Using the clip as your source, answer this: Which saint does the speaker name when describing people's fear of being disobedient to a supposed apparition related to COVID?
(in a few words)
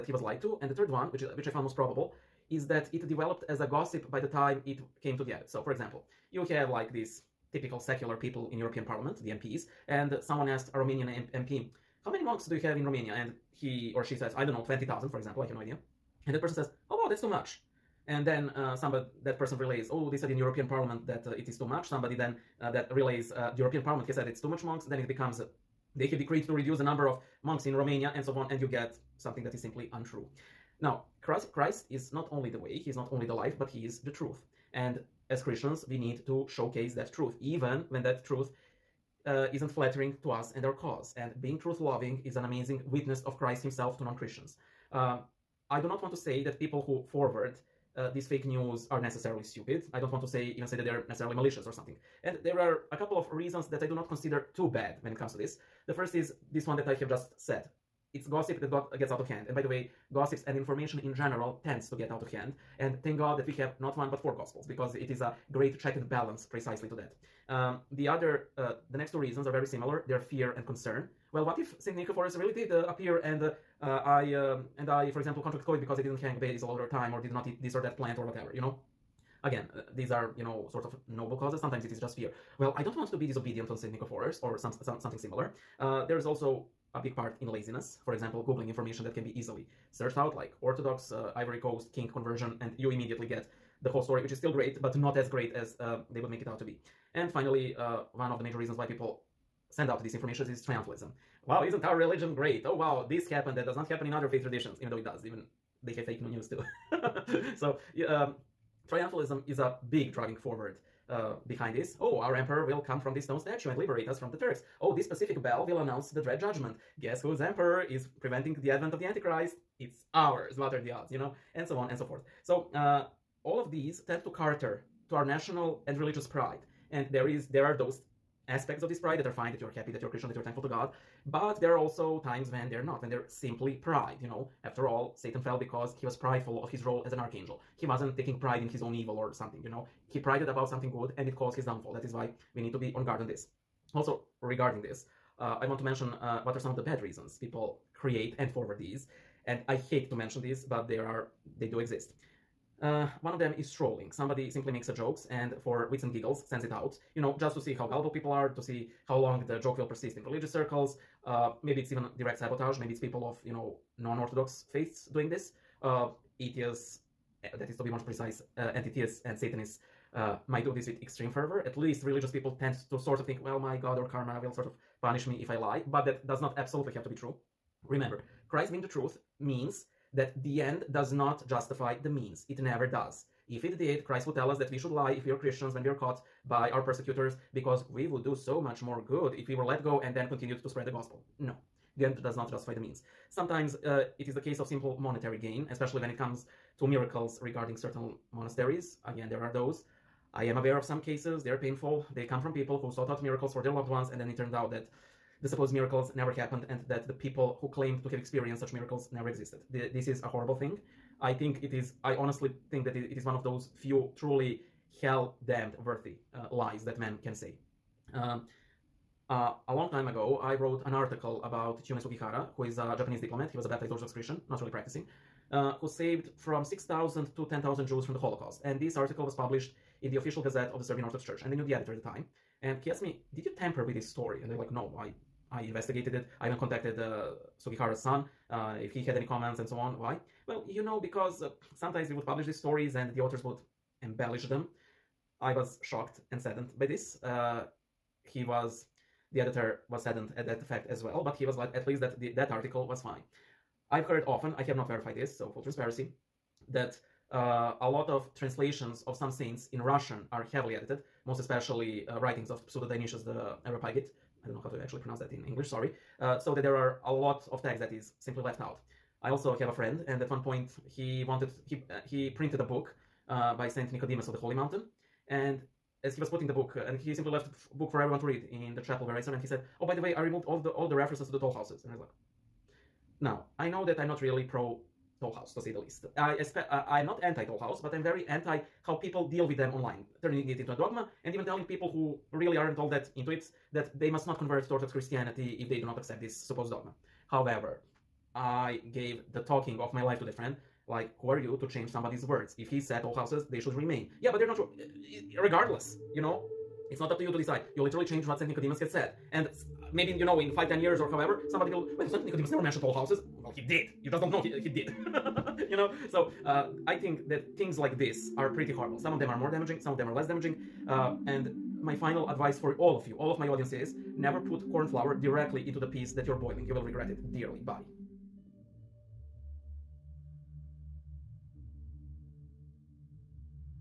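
Saint Nicephorus.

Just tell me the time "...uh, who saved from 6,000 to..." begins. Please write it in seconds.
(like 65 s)
225 s.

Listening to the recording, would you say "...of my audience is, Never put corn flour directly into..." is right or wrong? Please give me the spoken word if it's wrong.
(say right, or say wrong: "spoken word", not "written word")
right.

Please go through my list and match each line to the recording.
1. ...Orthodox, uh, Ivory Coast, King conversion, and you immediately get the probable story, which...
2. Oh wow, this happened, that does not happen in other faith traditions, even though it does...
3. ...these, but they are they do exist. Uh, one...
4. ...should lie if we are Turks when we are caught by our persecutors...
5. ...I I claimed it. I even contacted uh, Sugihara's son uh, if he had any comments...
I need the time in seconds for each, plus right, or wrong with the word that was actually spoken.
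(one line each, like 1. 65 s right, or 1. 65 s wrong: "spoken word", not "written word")
1. 90 s wrong: "whole", not "probable"
2. 102 s right
3. 150 s right
4. 184 s wrong: "Christians", not "Turks"
5. 234 s wrong: "investigated", not "claimed".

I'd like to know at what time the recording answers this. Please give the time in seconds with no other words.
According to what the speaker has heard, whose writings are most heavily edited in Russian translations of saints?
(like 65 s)
262 s.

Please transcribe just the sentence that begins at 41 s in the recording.
And being truth loving is an amazing witness of Christ himself to non Christians.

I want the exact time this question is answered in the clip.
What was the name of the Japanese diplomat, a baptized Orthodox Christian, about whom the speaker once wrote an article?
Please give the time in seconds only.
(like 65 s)
221 s.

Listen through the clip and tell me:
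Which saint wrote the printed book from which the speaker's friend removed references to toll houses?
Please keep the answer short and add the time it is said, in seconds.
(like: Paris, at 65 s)
Saint Nicodemus of the Holy Mountain, at 273 s.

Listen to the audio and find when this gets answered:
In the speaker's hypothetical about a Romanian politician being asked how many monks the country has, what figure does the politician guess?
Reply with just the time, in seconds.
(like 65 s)
14 s.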